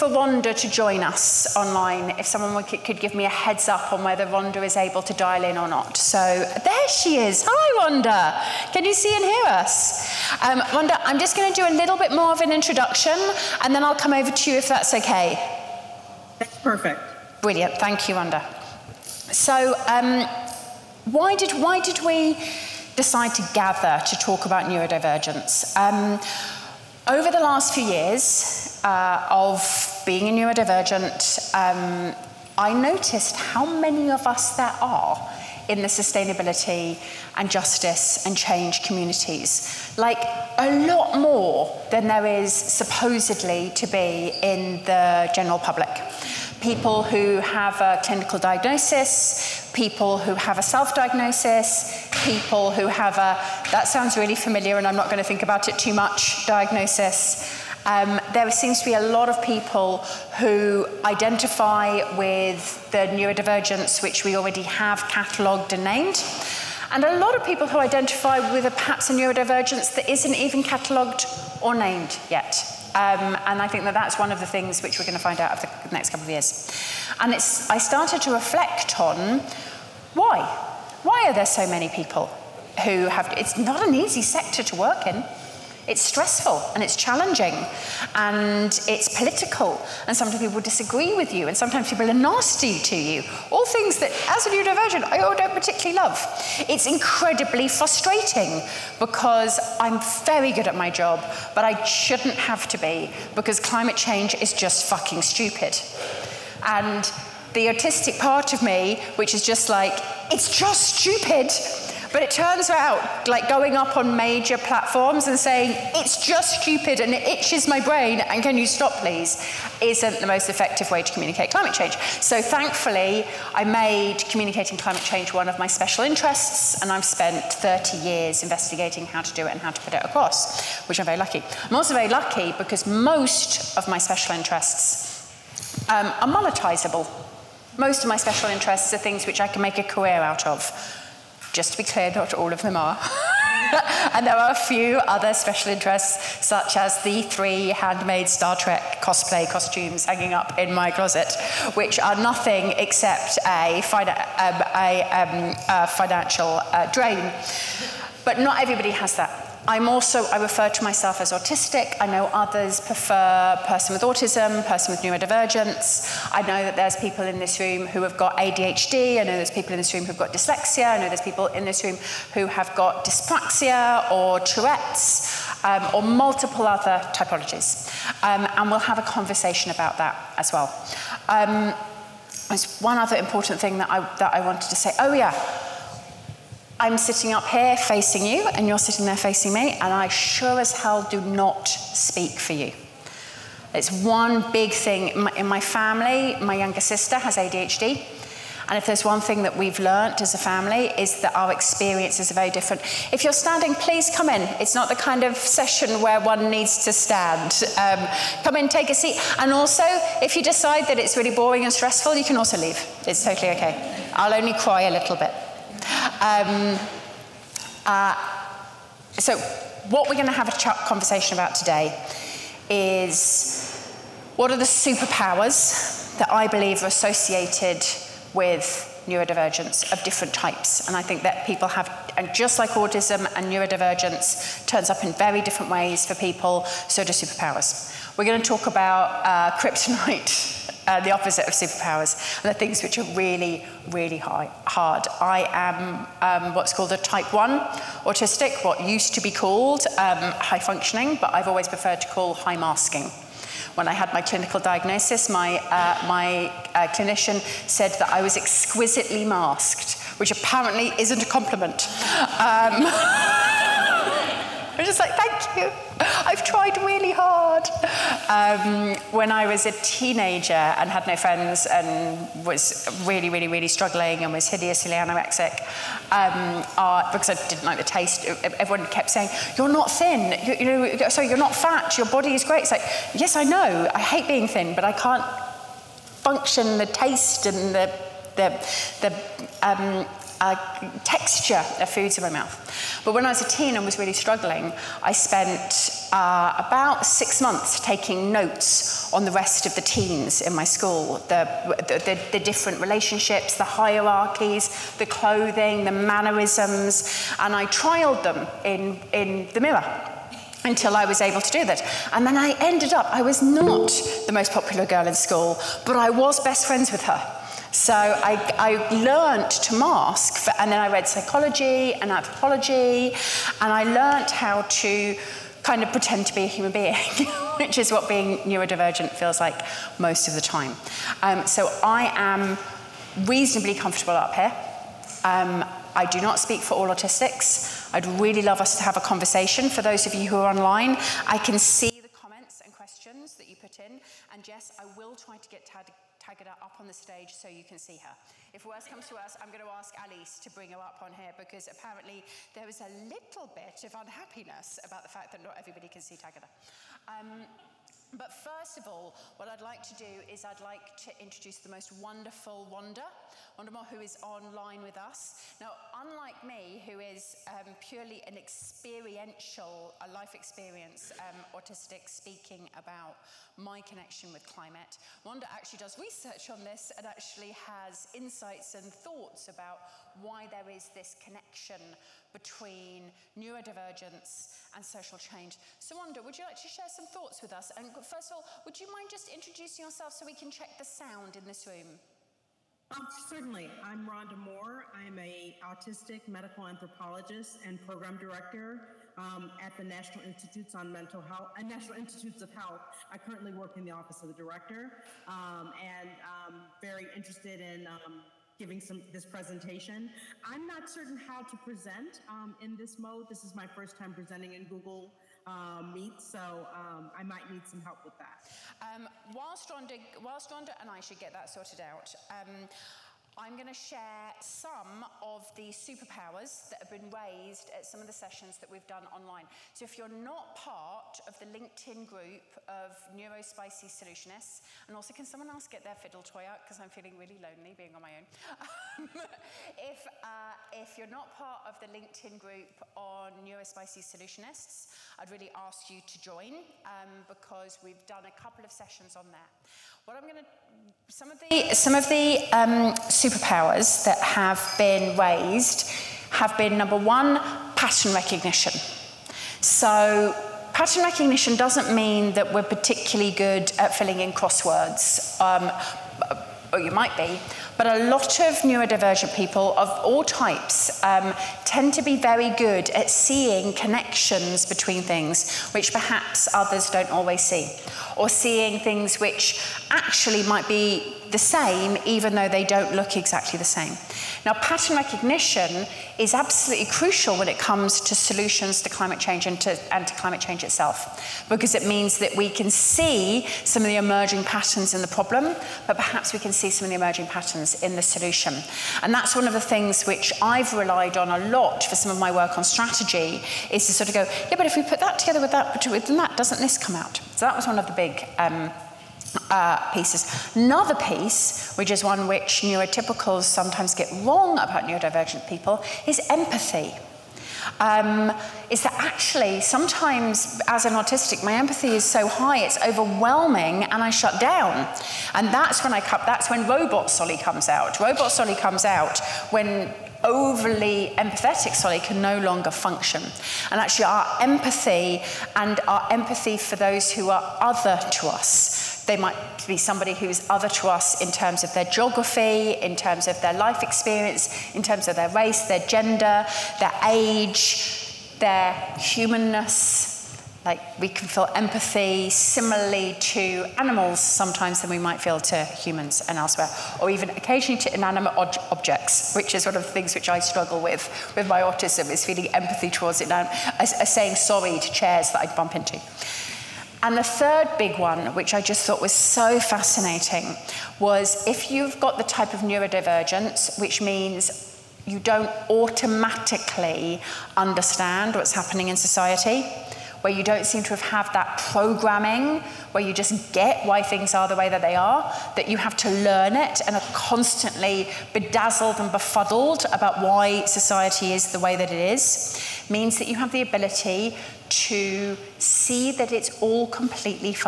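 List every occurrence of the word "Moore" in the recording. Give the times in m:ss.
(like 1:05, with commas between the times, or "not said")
6:03, 6:34.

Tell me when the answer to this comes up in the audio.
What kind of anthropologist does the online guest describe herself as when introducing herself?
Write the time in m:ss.
6:36.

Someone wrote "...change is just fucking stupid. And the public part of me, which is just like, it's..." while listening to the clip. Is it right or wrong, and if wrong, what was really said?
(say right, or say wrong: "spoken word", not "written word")
wrong: "autistic", not "public".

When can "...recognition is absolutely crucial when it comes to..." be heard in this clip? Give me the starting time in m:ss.
8:04.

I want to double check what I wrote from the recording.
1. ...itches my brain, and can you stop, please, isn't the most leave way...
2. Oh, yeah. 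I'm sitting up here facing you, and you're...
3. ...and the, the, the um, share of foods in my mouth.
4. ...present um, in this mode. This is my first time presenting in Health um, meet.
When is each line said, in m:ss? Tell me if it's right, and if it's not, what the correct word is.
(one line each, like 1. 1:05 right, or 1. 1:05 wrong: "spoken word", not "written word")
1. 1:57 wrong: "effective", not "leave"
2. 3:04 right
3. 4:47 wrong: "texture", not "share"
4. 6:51 wrong: "Google", not "Health".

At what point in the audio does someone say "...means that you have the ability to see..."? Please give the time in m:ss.
9:52.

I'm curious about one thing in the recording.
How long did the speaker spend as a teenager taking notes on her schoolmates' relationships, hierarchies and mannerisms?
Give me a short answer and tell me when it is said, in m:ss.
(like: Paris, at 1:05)
six months, at 4:57.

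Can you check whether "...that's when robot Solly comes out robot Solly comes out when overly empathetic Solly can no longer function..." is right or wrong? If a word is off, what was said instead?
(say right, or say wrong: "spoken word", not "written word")
right.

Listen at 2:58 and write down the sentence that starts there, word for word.
Um, and we'll have a conversation about that as well.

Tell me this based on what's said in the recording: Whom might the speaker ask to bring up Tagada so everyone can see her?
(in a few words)
Alice.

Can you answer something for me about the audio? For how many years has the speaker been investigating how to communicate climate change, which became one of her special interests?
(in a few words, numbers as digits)
30.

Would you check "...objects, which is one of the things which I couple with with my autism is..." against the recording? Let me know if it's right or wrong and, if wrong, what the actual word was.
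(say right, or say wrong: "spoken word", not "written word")
wrong: "struggle", not "couple".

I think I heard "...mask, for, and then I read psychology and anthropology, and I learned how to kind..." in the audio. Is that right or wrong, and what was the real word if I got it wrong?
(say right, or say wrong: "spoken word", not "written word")
right.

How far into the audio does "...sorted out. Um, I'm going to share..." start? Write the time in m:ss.
7:01.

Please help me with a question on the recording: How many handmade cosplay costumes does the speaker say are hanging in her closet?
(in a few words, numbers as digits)
3.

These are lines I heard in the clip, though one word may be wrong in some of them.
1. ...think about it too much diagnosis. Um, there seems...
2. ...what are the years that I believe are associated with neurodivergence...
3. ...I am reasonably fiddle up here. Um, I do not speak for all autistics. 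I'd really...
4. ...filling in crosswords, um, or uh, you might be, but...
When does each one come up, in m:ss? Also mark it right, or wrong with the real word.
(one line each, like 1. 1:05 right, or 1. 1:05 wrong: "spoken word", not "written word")
1. 0:55 right
2. 3:44 wrong: "superpowers", not "years"
3. 5:31 wrong: "comfortable", not "fiddle"
4. 7:43 right.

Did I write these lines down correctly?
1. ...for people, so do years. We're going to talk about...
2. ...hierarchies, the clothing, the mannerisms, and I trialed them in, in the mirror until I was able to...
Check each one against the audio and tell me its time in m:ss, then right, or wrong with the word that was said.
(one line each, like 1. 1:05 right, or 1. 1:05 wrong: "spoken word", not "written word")
1. 3:56 wrong: "superpowers", not "years"
2. 5:03 right.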